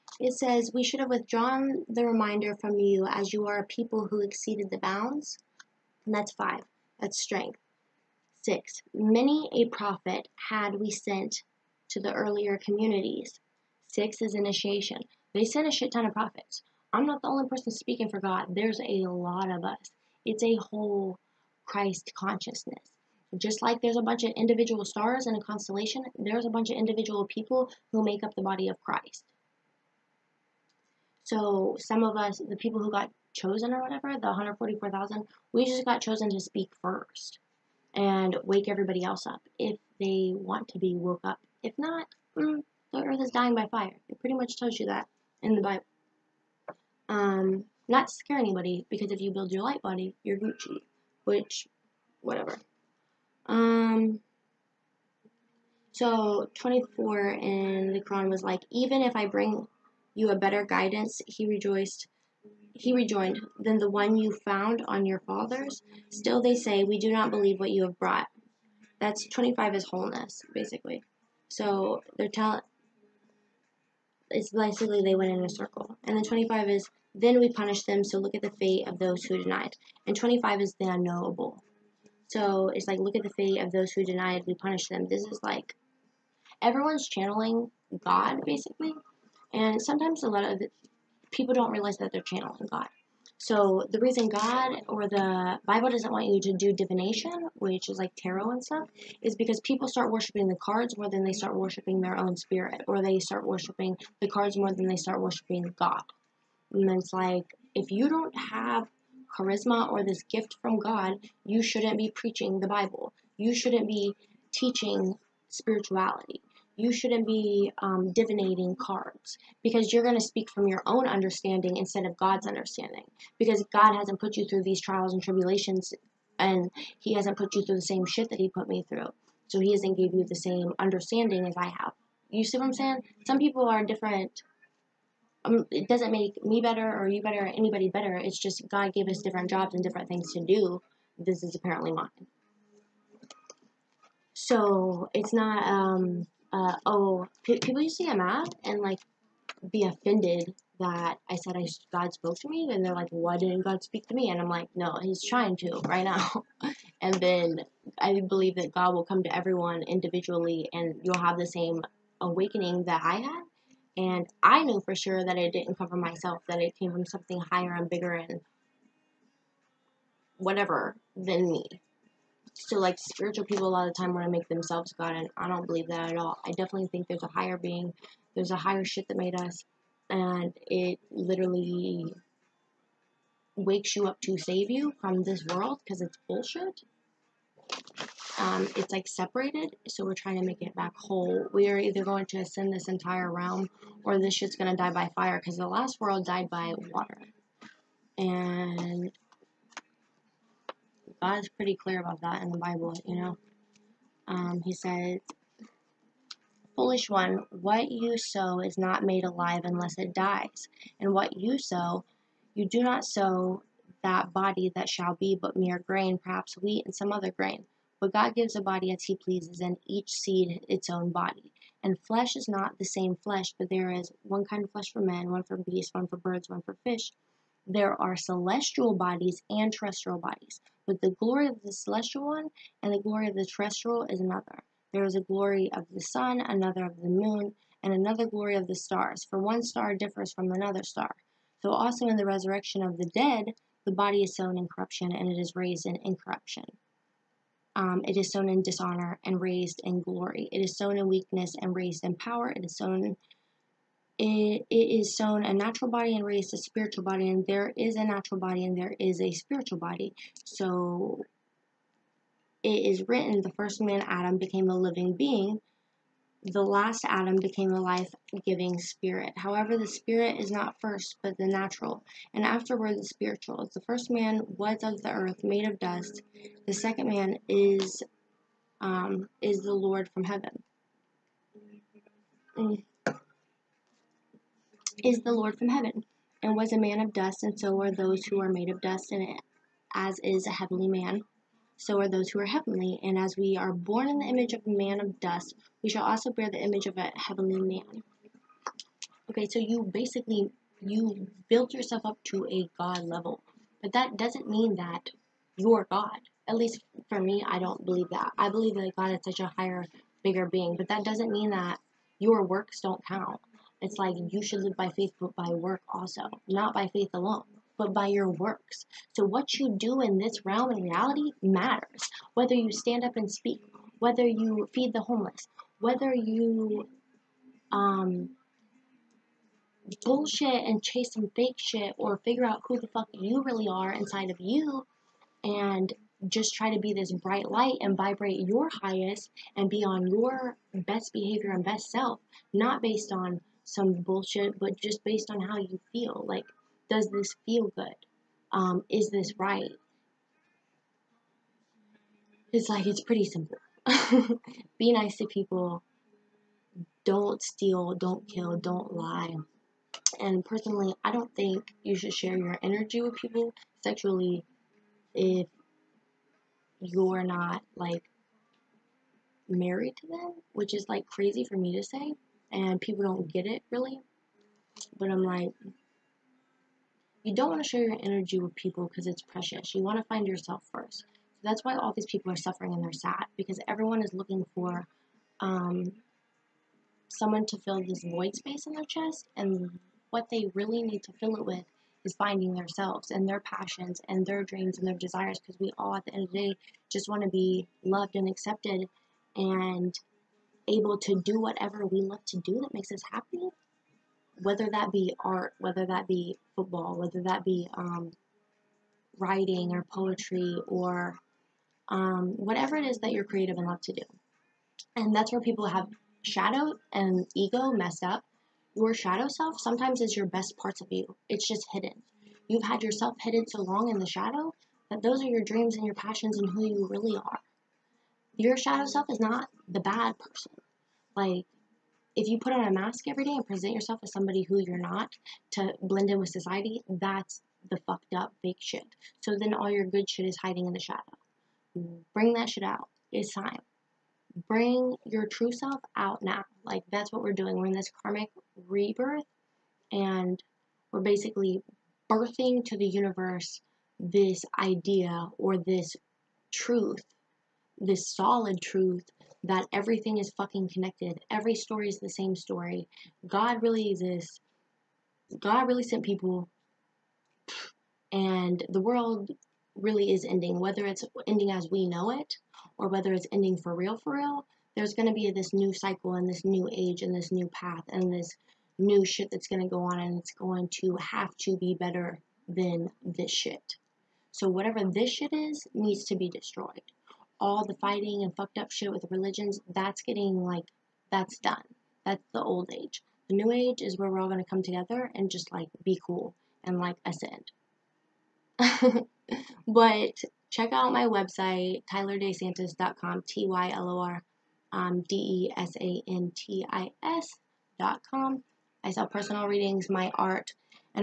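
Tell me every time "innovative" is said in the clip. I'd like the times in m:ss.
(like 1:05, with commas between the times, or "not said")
not said.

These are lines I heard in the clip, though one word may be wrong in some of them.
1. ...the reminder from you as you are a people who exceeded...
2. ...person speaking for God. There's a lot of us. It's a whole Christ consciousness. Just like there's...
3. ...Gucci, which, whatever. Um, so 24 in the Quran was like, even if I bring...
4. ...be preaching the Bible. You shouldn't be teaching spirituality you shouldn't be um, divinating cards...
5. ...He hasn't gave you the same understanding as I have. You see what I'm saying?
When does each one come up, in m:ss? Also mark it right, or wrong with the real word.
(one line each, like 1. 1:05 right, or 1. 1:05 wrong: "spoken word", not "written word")
1. 0:01 right
2. 0:17 right
3. 0:50 right
4. 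1:51 right
5. 2:09 right.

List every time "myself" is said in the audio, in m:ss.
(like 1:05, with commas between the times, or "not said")
2:45.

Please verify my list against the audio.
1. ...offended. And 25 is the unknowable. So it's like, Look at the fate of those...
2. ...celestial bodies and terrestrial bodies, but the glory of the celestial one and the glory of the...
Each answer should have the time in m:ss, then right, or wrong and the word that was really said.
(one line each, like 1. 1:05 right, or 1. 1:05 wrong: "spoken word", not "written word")
1. 1:19 wrong: "denied", not "offended"
2. 3:48 right.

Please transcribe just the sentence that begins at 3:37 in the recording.
But God gives a body as He pleases, and each seed its own body.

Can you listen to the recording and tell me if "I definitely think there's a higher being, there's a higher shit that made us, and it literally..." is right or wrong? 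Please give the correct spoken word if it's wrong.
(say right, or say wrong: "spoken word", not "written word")
right.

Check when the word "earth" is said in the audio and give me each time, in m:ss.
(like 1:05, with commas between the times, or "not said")
0:43, 4:35.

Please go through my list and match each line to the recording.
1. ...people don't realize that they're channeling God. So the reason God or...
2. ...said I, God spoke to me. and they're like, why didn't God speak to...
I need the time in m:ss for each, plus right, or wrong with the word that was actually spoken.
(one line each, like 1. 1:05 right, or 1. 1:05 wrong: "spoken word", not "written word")
1. 1:31 right
2. 2:31 right.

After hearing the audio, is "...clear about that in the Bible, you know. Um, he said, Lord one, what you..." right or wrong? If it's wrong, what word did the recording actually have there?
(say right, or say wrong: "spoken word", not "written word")
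wrong: "Foolish", not "Lord".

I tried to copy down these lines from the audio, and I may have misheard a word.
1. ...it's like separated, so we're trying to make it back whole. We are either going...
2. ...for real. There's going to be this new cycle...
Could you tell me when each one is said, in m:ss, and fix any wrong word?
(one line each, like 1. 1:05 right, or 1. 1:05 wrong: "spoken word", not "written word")
1. 3:08 right
2. 7:53 right.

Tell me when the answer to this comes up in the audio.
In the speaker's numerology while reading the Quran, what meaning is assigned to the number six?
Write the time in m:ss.
0:13.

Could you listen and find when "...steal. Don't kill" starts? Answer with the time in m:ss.
5:57.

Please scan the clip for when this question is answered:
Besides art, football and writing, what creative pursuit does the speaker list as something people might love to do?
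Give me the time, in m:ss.
6:49.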